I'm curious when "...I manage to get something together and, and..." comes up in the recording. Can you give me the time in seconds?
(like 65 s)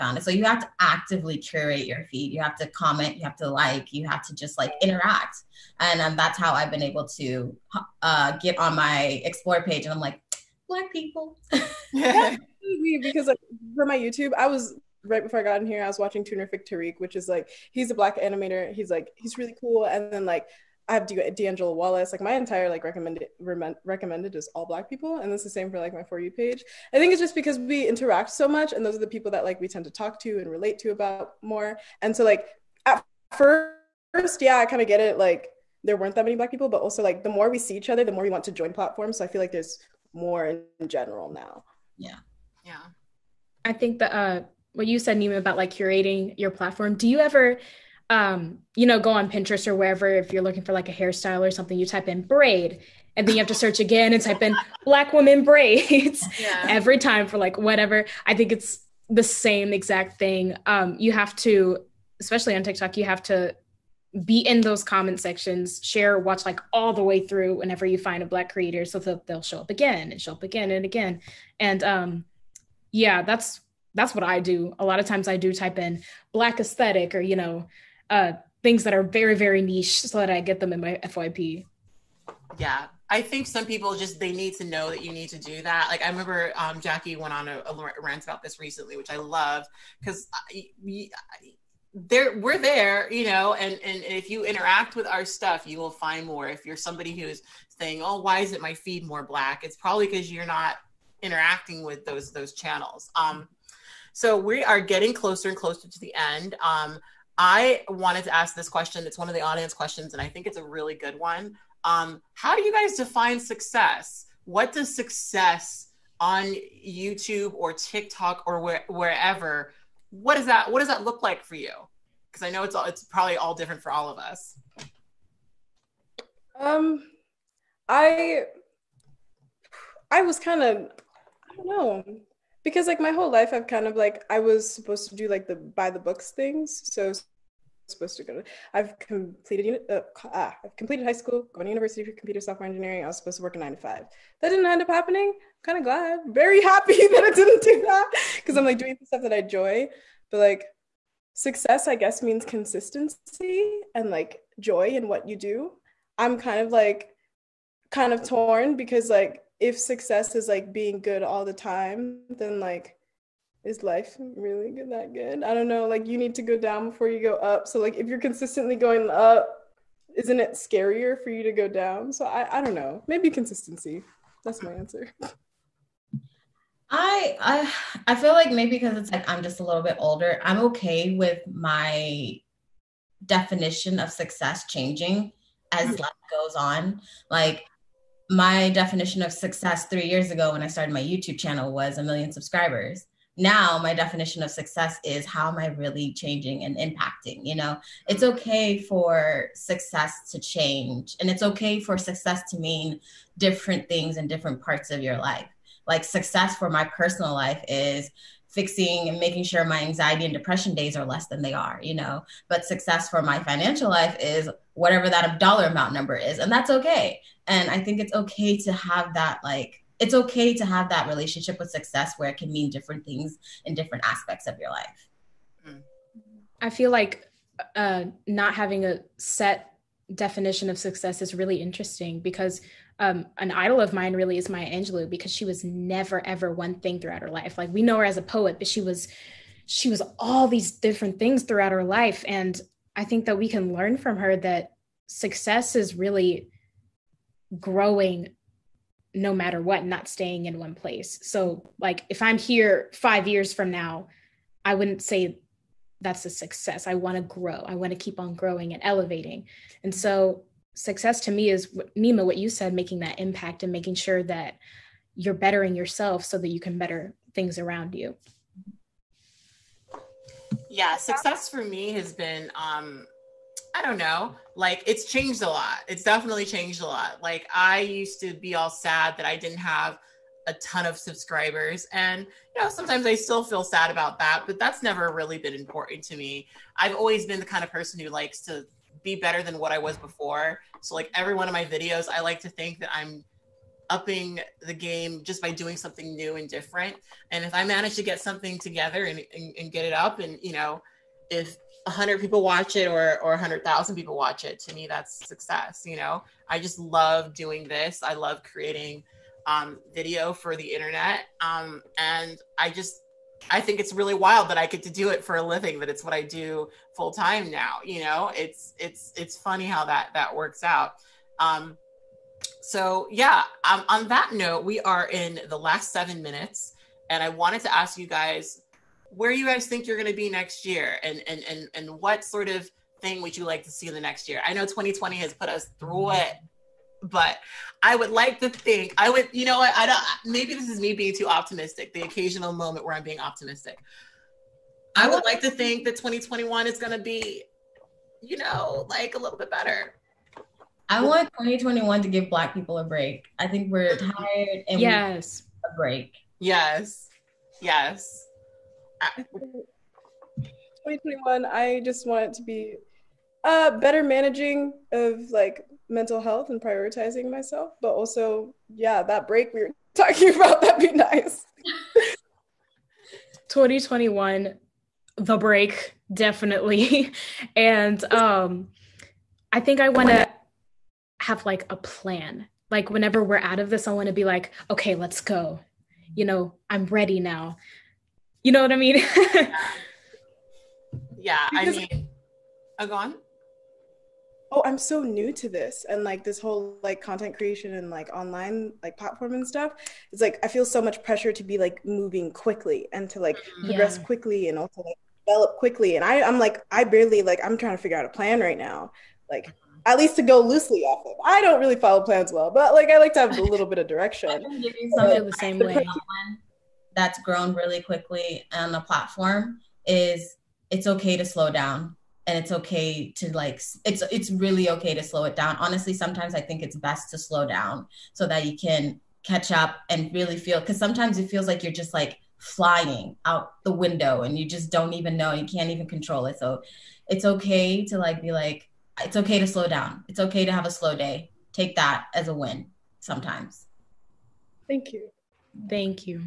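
297 s.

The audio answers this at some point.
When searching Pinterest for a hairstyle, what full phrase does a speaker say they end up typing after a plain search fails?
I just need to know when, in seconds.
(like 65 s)
54 s.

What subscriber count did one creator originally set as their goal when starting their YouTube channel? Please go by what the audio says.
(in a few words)
1 million.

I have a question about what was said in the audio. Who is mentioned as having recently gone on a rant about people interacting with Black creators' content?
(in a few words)
Jackie.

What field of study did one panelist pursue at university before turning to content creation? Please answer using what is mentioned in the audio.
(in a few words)
computer software engineering.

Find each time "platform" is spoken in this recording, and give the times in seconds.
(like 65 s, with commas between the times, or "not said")
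38 s, 46 s, 398 s, 418 s.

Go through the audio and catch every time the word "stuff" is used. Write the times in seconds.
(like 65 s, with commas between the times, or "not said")
95 s, 149 s, 399 s.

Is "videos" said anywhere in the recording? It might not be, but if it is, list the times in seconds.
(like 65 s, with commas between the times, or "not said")
291 s, 309 s.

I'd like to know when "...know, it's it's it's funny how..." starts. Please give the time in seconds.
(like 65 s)
318 s.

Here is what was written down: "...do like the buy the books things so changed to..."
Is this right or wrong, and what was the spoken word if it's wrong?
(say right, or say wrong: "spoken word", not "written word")
wrong: "supposed", not "changed".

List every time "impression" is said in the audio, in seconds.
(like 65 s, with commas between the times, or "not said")
not said.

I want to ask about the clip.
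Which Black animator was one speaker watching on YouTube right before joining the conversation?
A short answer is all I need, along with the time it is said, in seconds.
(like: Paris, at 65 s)
Tunerific Tariq, at 16 s.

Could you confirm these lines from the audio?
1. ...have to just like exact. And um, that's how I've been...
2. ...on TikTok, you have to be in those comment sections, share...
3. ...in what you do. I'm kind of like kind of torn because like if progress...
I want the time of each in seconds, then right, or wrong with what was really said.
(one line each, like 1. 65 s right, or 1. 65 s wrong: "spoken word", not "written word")
1. 4 s wrong: "interact", not "exact"
2. 62 s right
3. 154 s wrong: "success", not "progress".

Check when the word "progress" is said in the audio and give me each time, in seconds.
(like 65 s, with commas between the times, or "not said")
403 s.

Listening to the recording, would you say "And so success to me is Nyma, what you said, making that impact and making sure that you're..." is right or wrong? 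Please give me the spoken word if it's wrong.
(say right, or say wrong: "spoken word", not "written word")
right.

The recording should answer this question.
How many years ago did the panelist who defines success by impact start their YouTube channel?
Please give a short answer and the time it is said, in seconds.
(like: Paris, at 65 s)
3, at 189 s.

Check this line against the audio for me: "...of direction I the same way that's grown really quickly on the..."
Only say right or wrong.
right.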